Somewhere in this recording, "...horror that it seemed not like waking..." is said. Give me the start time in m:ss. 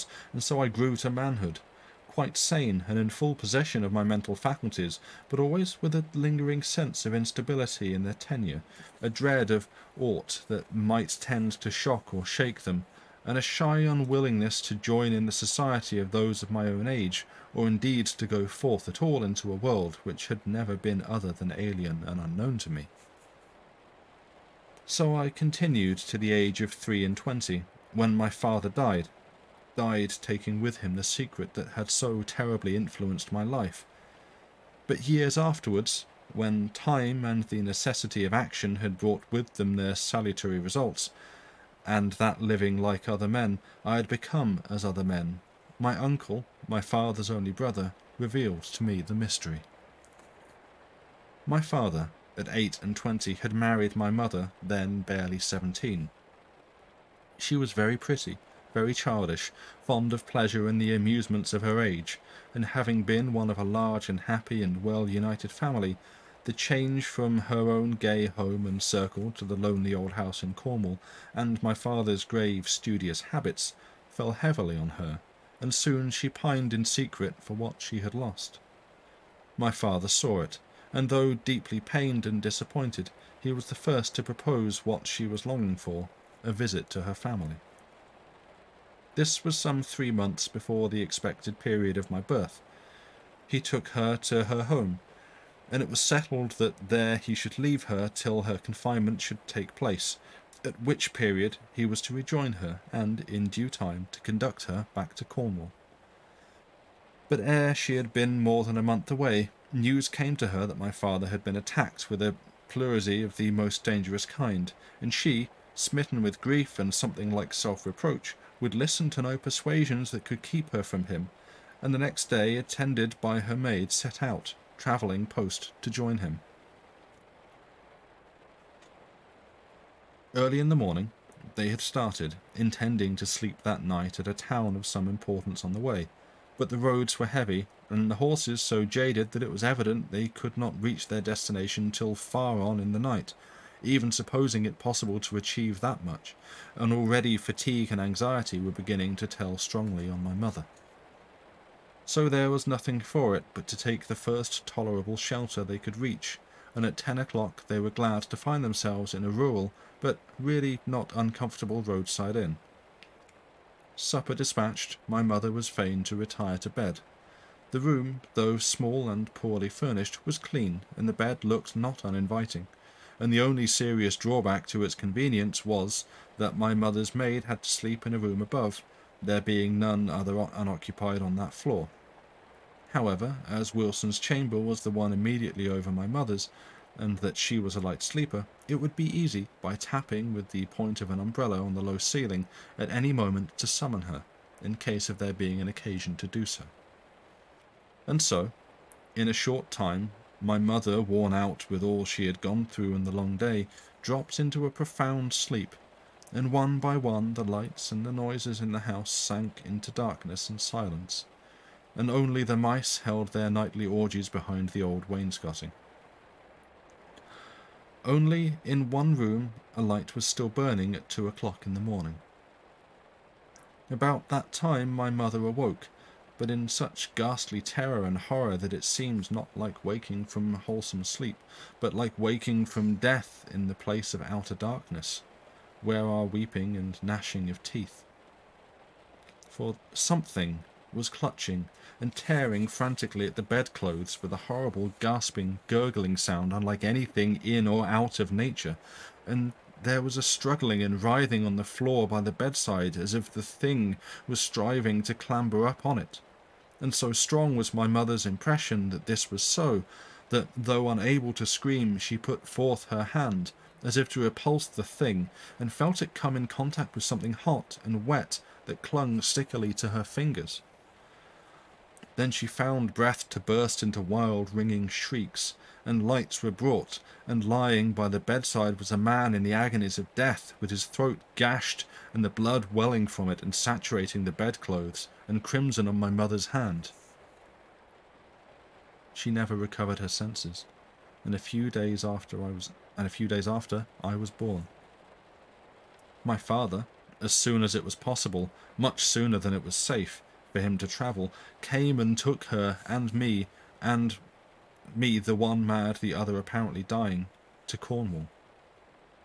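3:48.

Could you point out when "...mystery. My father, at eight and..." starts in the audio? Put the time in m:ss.
0:49.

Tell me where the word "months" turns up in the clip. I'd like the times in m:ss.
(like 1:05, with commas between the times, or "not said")
1:30, 1:48.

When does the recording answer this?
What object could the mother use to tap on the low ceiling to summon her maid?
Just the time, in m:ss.
3:11.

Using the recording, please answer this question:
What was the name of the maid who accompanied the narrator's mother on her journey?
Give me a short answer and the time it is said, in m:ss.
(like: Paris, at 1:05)
Wilson, at 3:03.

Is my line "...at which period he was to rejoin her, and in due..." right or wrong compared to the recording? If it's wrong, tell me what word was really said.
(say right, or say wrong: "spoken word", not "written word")
right.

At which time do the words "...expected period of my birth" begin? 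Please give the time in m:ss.
1:31.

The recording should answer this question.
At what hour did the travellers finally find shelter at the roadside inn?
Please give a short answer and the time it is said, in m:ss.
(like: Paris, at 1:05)
10 o'clock, at 2:36.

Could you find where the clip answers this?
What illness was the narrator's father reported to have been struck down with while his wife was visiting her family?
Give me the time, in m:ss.
1:52.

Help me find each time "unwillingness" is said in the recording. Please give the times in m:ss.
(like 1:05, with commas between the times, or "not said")
0:13.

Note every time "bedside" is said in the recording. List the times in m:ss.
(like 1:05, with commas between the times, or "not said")
4:12, 4:38.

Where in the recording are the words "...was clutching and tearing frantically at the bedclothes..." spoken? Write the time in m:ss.
4:00.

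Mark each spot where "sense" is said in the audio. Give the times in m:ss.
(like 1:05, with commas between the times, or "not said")
0:06, 4:50.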